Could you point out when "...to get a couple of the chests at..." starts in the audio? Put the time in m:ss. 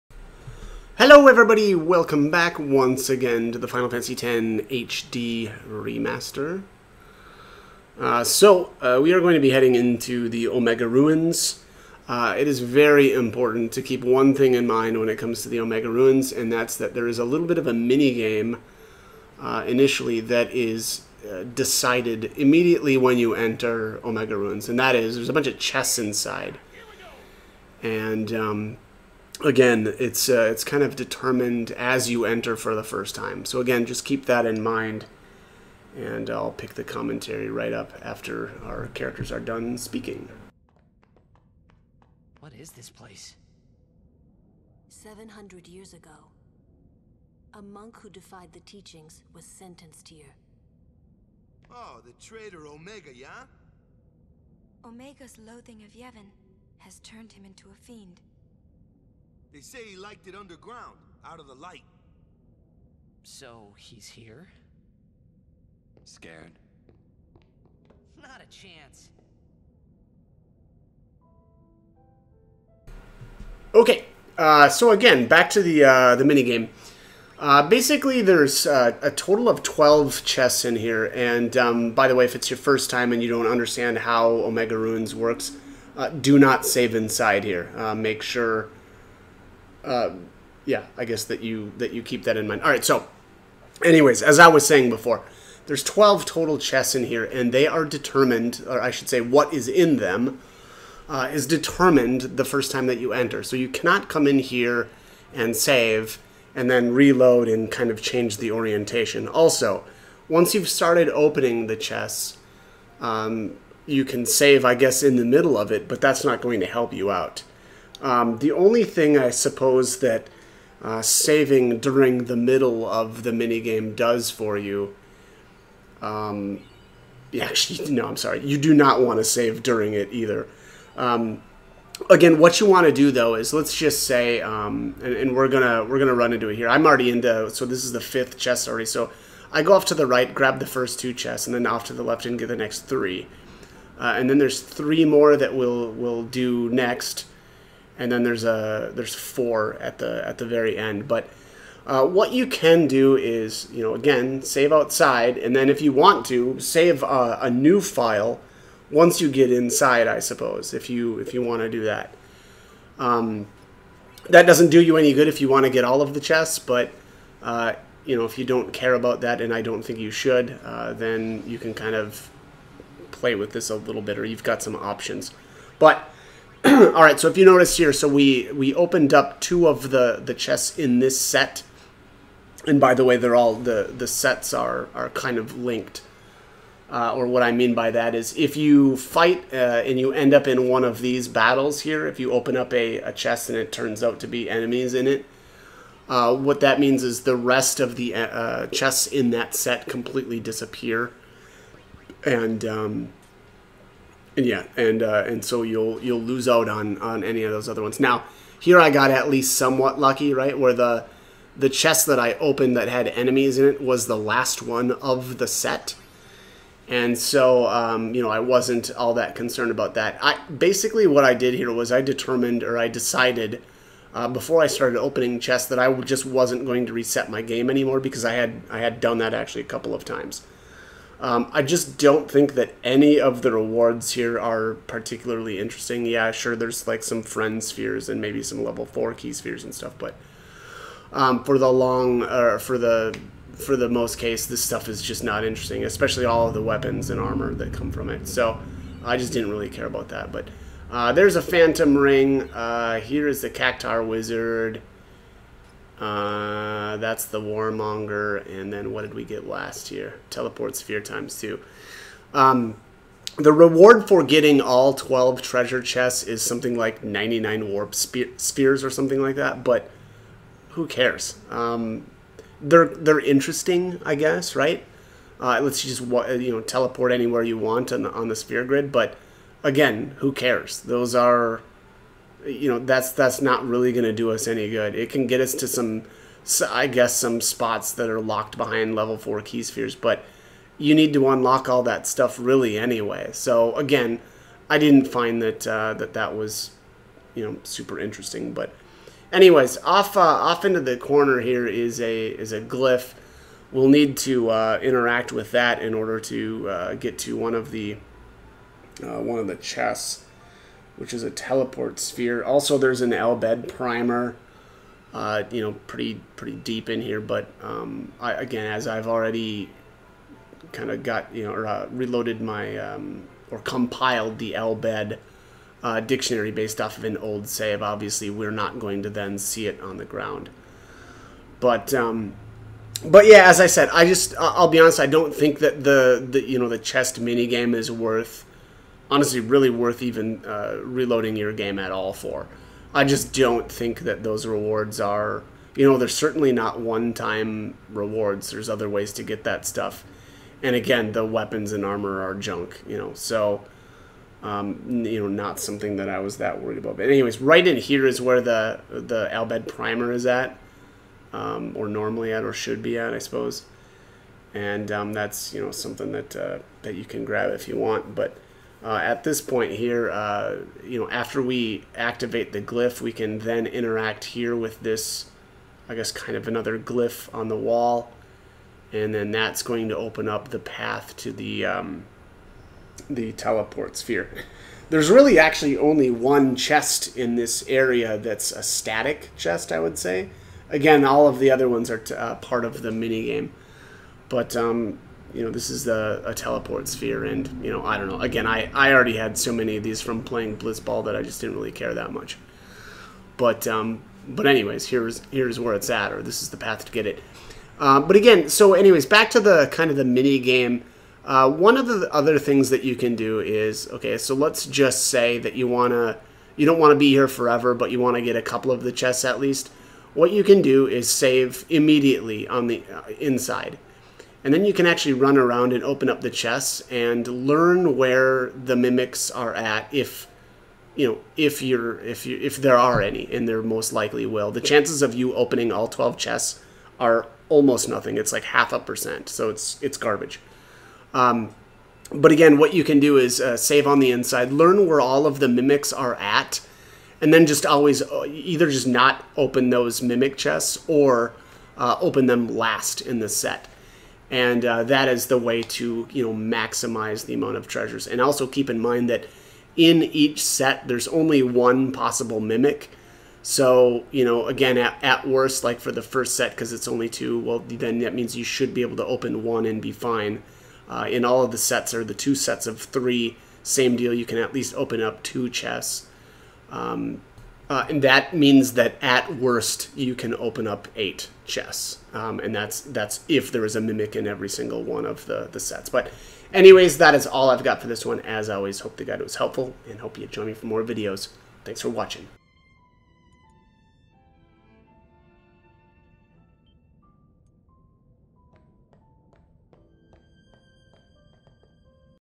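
6:58.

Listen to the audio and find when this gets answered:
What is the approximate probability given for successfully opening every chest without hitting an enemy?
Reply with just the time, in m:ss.
7:18.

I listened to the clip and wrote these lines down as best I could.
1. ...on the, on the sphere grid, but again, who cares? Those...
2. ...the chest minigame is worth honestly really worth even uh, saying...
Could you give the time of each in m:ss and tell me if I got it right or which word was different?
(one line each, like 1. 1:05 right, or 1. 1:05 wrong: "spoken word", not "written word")
1. 4:37 right
2. 5:36 wrong: "reloading", not "saying".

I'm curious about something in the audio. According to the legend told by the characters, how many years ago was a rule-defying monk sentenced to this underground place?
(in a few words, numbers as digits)
700.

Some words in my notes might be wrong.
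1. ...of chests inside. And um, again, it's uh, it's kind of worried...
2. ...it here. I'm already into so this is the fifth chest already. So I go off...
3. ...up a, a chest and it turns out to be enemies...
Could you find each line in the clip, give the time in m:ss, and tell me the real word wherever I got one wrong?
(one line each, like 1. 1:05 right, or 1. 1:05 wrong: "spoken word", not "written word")
1. 0:25 wrong: "determined", not "worried"
2. 2:16 right
3. 3:12 right.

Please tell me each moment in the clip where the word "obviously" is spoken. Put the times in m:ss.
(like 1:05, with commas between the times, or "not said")
5:27.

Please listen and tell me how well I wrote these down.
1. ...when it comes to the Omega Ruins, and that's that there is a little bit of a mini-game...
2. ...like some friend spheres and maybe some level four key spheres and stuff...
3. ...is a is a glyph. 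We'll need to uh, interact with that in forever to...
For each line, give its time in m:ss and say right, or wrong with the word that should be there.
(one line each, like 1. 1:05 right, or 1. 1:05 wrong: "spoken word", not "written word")
1. 0:14 right
2. 3:56 right
3. 5:01 wrong: "order", not "forever".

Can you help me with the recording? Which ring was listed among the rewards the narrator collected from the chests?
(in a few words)
Phantom Ring.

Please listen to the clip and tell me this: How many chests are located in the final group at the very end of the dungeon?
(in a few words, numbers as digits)
4.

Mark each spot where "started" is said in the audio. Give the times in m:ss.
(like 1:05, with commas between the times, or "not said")
1:50, 3:44.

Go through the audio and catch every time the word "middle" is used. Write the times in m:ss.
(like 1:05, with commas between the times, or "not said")
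1:55, 2:02.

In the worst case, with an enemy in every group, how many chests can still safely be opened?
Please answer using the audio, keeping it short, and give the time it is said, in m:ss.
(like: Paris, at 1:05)
8, at 8:00.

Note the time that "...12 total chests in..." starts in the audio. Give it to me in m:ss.
1:35.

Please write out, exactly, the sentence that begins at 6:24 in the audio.
There's really actually only one chest in this area that's a static chest, I would say.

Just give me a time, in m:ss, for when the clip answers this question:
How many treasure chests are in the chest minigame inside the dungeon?
1:19.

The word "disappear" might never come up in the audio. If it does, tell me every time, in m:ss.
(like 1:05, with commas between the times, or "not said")
3:20.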